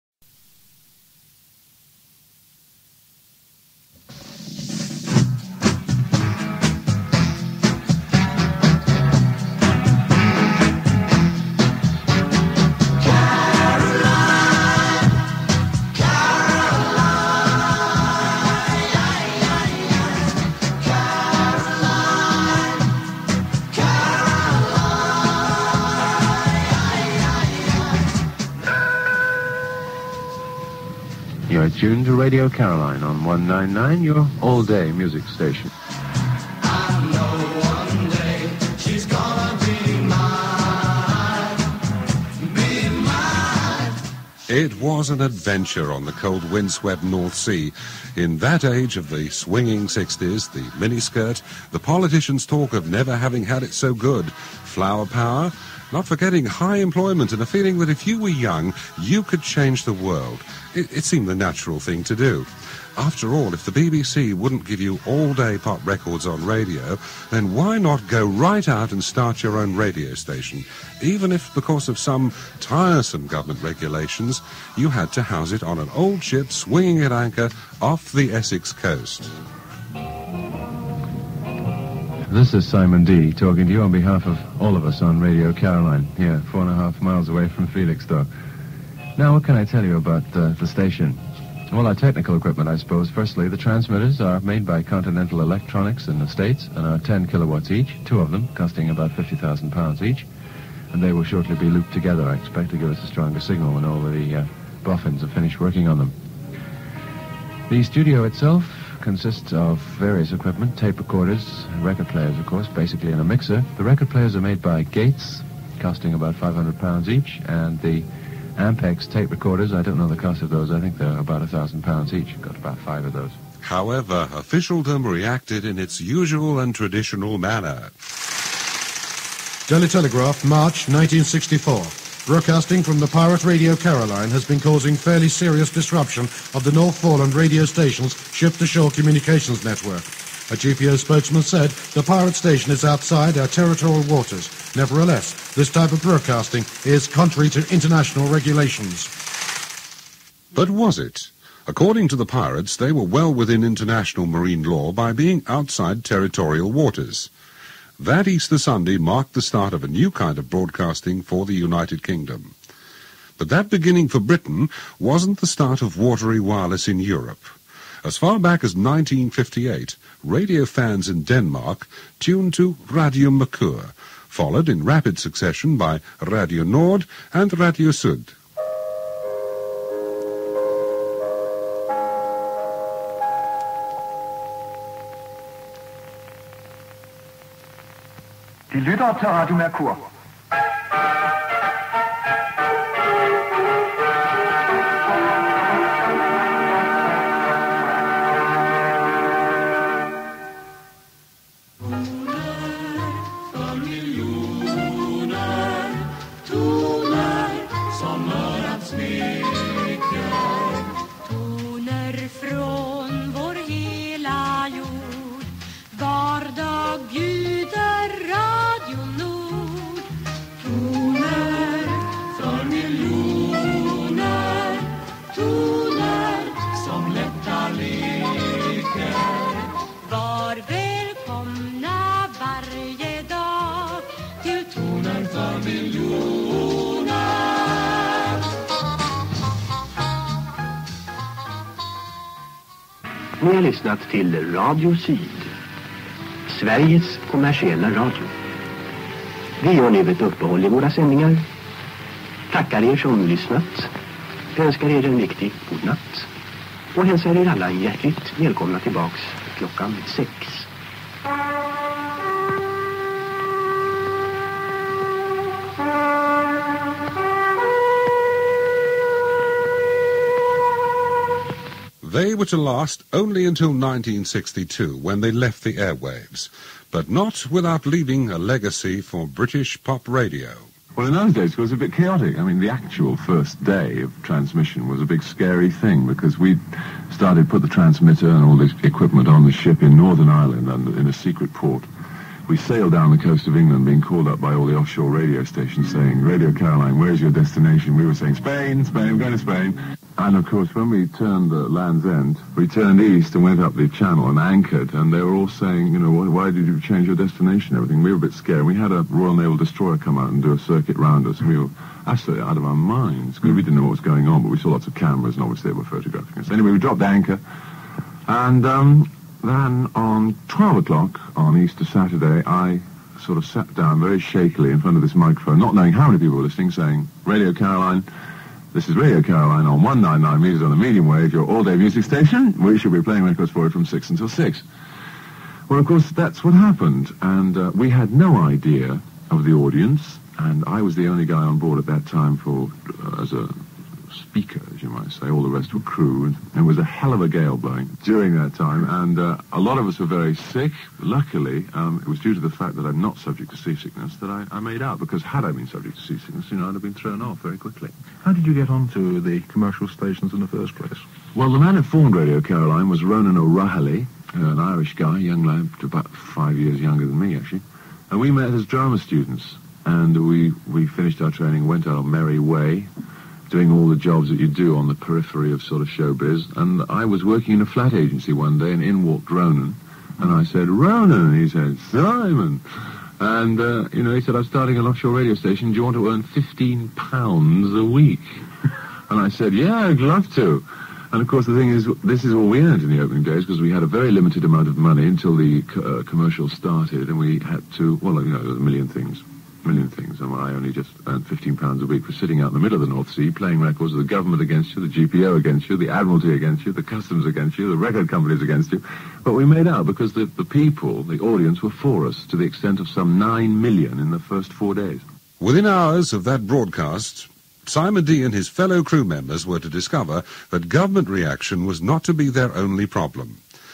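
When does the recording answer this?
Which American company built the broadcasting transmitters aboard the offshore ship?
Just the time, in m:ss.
1:34.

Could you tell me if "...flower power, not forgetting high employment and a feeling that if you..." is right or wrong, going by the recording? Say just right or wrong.
right.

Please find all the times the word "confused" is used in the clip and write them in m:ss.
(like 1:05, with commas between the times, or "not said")
not said.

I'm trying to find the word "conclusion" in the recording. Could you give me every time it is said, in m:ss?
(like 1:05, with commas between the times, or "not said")
not said.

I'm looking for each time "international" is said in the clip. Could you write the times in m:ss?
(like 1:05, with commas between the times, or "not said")
2:27, 2:33.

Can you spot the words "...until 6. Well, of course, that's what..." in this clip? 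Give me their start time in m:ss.
5:34.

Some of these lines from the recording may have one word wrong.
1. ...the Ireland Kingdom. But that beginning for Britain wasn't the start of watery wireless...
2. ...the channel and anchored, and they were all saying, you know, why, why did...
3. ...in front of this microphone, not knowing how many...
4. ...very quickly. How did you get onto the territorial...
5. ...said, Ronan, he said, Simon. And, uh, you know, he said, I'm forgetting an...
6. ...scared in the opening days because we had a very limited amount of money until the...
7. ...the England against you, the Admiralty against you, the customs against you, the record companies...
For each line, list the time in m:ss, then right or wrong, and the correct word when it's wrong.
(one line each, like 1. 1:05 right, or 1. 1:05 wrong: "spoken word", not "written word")
1. 2:41 wrong: "United", not "Ireland"
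2. 5:03 right
3. 5:24 right
4. 5:57 wrong: "commercial", not "territorial"
5. 6:20 wrong: "starting", not "forgetting"
6. 6:32 wrong: "earned", not "scared"
7. 6:44 wrong: "GPO", not "England".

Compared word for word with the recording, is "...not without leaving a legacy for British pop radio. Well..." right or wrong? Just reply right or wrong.
right.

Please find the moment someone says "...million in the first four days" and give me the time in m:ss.
6:53.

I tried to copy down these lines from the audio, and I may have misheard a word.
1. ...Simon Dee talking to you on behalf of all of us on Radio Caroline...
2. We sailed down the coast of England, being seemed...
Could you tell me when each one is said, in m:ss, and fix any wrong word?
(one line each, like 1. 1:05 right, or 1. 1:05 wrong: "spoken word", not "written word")
1. 1:22 right
2. 4:52 wrong: "called", not "seemed".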